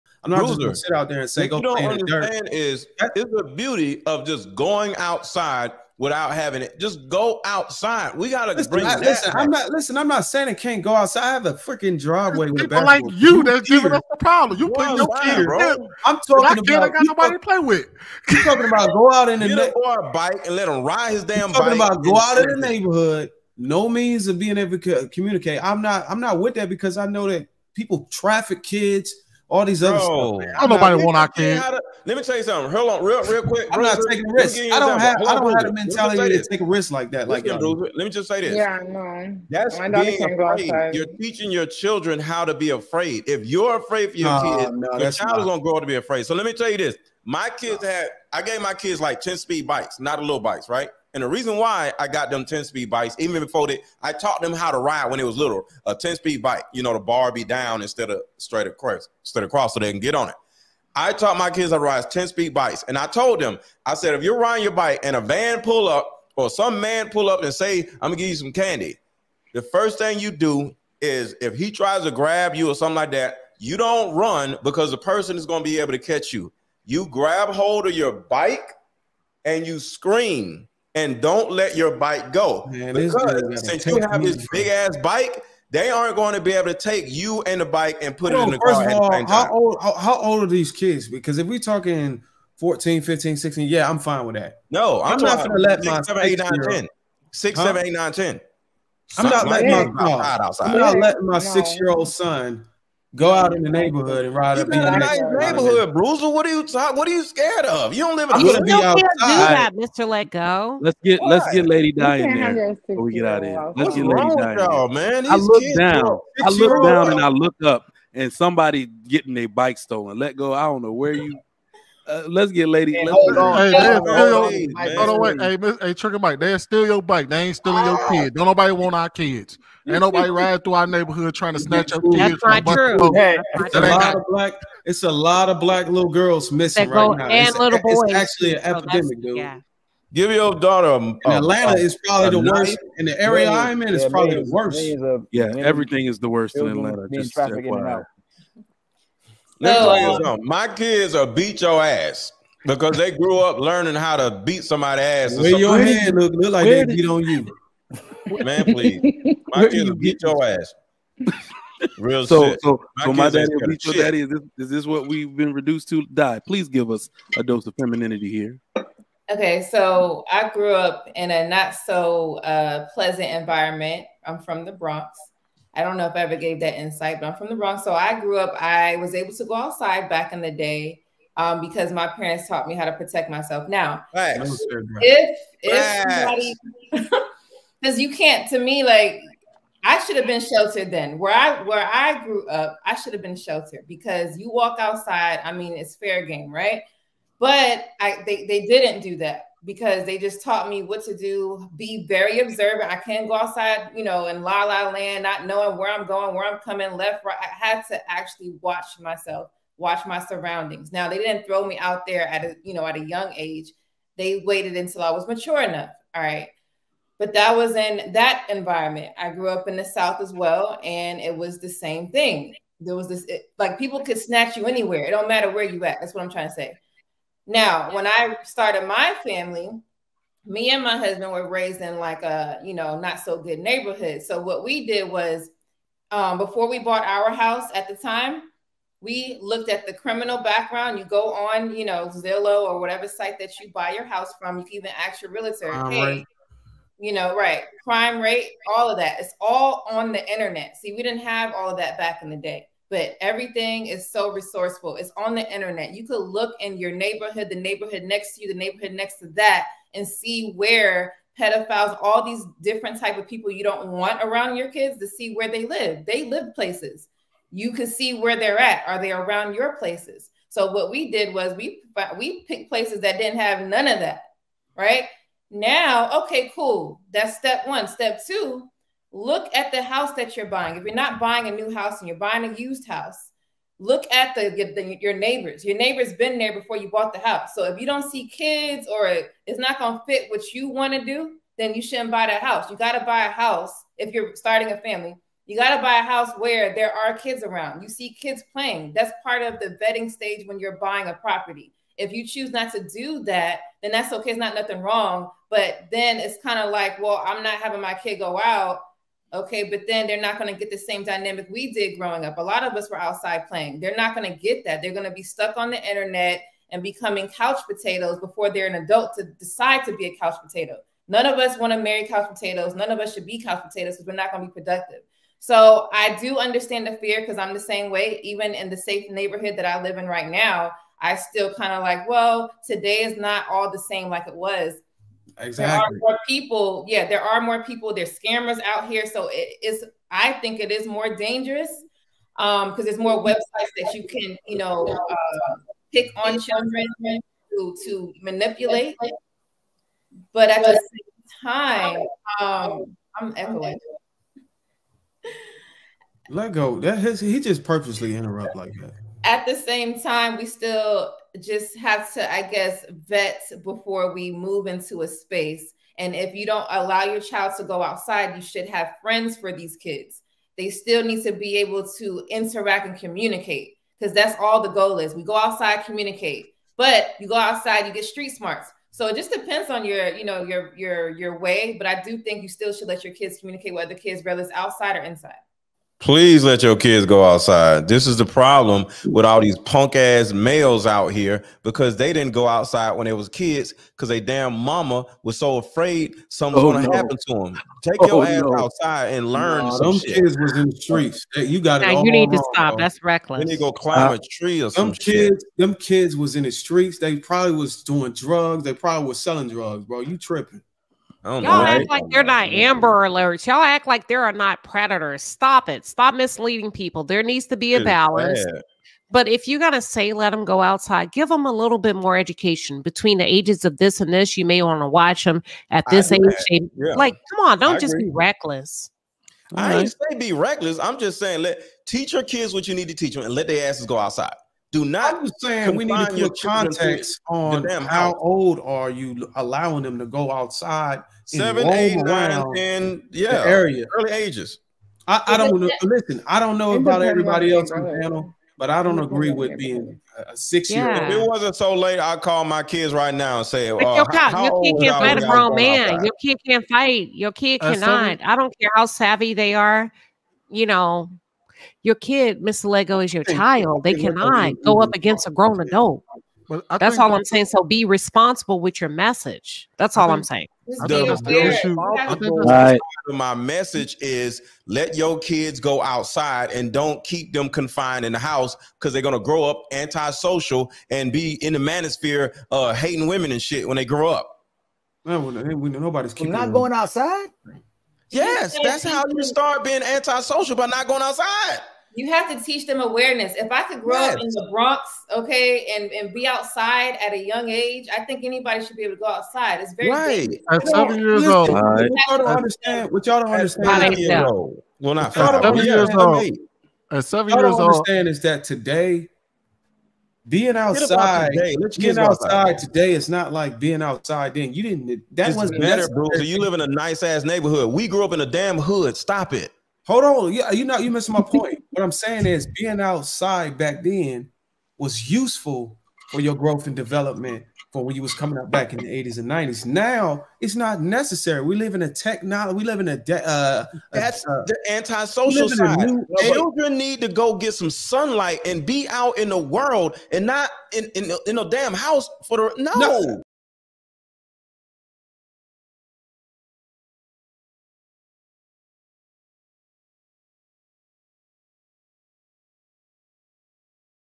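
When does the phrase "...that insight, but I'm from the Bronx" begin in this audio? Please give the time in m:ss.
2:56.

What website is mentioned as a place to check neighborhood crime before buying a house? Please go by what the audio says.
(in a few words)
Zillow.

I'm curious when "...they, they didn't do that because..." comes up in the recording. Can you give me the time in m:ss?
3:18.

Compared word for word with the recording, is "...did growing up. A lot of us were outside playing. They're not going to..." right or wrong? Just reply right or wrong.
right.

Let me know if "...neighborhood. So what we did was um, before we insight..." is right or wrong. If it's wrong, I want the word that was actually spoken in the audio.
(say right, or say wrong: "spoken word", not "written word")
wrong: "bought", not "insight".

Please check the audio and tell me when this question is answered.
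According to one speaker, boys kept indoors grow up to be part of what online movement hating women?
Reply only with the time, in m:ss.
8:01.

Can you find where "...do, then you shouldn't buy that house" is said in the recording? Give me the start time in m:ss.
4:51.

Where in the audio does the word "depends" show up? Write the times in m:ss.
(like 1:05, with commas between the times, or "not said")
6:19.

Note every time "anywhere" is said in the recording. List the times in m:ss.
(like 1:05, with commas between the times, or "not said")
3:44.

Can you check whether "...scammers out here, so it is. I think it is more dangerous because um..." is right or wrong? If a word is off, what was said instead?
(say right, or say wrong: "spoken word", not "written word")
right.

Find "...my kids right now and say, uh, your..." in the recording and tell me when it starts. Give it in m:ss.
7:32.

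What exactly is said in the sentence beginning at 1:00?
I taught my kids how to ride 10 speed bikes.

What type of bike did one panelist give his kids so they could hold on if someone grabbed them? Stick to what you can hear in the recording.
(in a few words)
ten speed bikes.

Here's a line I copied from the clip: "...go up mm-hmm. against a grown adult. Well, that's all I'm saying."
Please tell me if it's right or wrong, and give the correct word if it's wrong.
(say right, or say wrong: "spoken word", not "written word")
right.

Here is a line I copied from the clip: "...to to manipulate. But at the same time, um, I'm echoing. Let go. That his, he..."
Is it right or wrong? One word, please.
right.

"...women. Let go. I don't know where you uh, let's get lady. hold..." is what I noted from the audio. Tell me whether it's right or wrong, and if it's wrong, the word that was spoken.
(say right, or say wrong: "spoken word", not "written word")
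wrong: "stolen", not "women".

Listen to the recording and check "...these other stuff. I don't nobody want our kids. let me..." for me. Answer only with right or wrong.
right.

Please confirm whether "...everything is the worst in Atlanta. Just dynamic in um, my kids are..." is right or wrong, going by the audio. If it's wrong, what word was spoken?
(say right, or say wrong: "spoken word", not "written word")
wrong: "traffic", not "dynamic".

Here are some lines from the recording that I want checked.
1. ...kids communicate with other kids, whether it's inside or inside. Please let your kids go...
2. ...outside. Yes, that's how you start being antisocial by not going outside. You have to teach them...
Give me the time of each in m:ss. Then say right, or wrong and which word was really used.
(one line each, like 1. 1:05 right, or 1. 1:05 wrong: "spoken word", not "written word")
1. 6:23 wrong: "outside", not "inside"
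2. 8:06 right.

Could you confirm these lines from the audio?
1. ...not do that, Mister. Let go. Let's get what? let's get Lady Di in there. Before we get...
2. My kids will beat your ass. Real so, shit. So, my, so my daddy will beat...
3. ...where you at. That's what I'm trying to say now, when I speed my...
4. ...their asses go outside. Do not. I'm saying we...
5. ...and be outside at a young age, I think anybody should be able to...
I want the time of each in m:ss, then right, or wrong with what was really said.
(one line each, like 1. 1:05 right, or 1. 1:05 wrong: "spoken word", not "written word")
1. 1:48 right
2. 2:39 right
3. 3:45 wrong: "started", not "speed"
4. 7:13 right
5. 8:15 right.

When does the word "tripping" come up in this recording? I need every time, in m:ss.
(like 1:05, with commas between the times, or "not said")
6:50.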